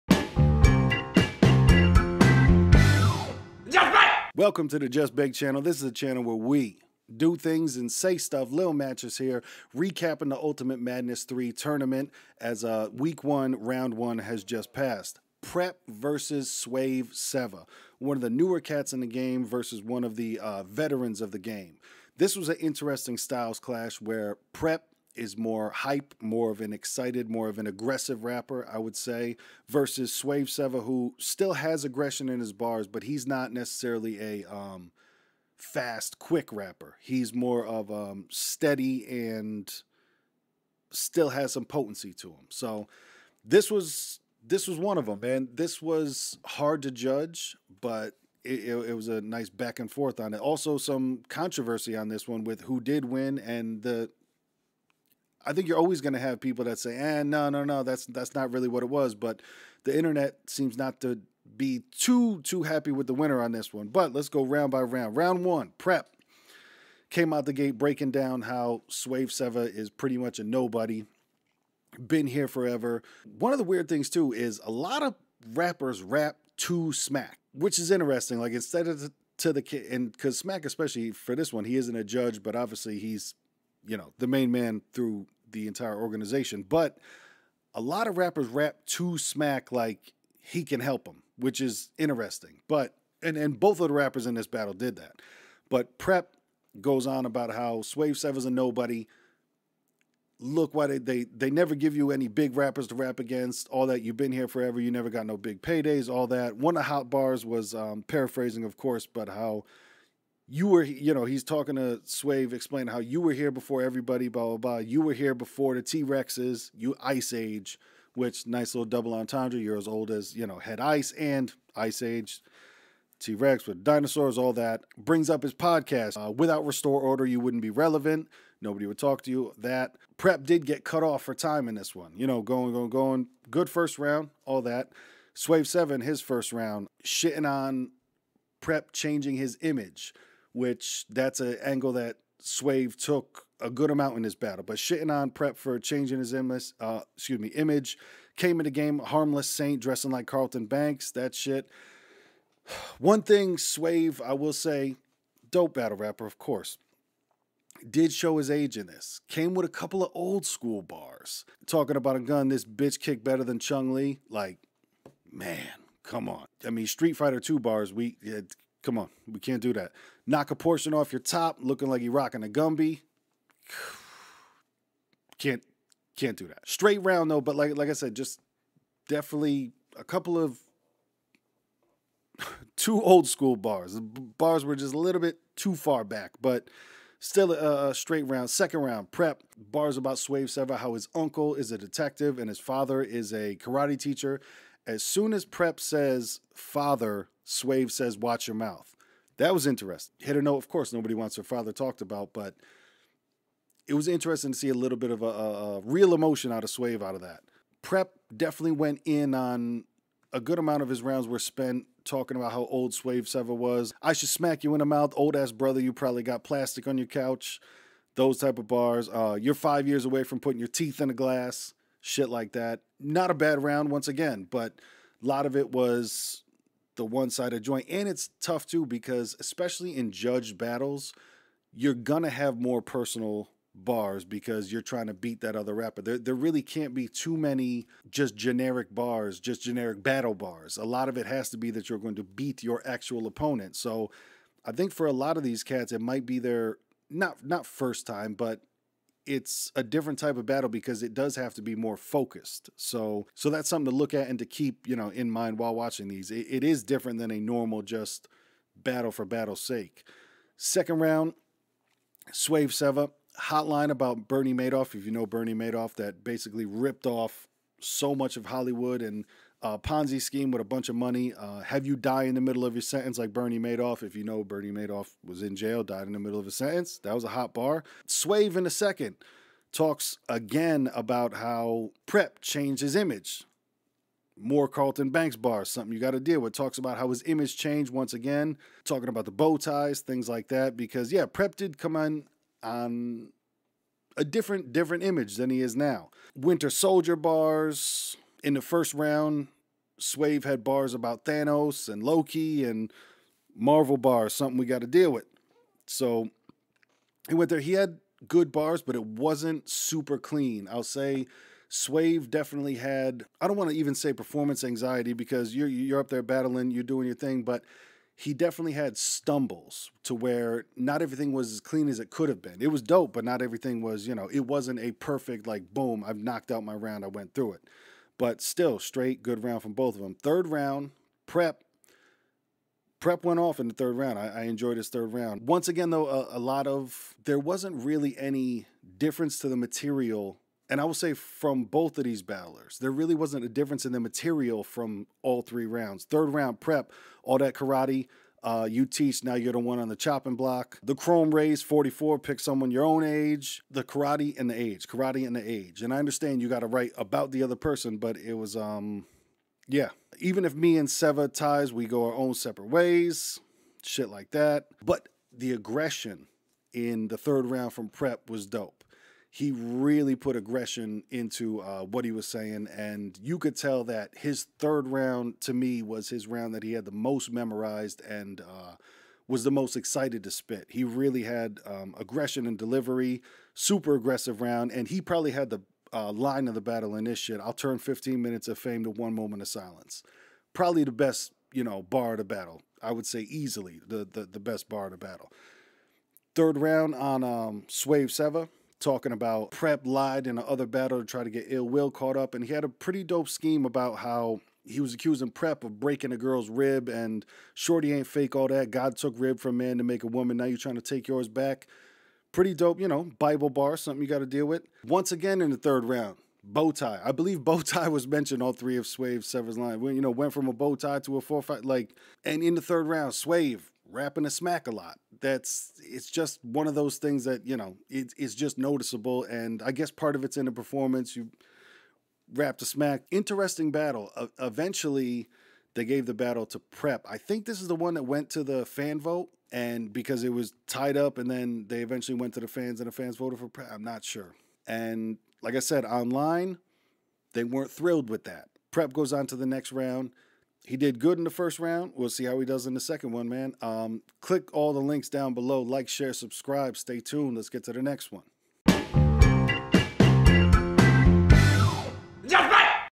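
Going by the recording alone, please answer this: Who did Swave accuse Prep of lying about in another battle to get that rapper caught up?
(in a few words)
Ill Will.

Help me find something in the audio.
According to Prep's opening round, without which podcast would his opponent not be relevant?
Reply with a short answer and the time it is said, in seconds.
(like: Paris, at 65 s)
Restore Order, at 126 s.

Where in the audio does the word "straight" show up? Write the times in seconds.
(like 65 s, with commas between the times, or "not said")
176 s, 187 s, 328 s.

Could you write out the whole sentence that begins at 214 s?
I should smack you in the mouth, old ass brother.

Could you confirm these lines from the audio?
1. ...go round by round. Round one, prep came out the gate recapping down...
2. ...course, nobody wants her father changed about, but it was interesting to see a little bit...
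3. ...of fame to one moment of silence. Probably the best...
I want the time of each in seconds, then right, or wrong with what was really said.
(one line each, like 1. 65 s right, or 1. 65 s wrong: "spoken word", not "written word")
1. 64 s wrong: "breaking", not "recapping"
2. 200 s wrong: "talked", not "changed"
3. 388 s right.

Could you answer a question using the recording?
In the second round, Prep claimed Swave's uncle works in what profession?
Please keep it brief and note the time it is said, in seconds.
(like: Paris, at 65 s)
Detective, at 191 s.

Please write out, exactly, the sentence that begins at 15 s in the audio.
Prep versus Swave Sevah, one of the newer cats in the game versus one of the uh, veterans of the game.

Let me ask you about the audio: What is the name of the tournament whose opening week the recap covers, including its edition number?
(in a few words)
Ultimate Madness 3.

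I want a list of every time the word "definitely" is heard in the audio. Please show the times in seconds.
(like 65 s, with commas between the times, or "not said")
179 s, 208 s, 312 s, 318 s.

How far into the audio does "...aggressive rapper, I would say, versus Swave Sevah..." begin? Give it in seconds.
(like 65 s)
27 s.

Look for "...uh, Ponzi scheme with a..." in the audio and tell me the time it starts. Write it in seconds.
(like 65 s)
269 s.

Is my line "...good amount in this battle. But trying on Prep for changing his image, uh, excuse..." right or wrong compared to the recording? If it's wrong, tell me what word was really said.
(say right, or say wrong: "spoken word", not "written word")
wrong: "shitting", not "trying".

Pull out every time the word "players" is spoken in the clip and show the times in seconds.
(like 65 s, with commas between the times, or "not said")
not said.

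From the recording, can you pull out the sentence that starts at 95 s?
But Prep goes on about how Swave Sevah's a nobody.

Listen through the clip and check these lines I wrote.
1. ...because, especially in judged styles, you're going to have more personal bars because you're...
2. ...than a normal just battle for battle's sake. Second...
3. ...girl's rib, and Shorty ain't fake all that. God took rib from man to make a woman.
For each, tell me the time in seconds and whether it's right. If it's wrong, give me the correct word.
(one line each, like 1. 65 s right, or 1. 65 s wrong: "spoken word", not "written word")
1. 228 s wrong: "battles", not "styles"
2. 257 s right
3. 406 s right.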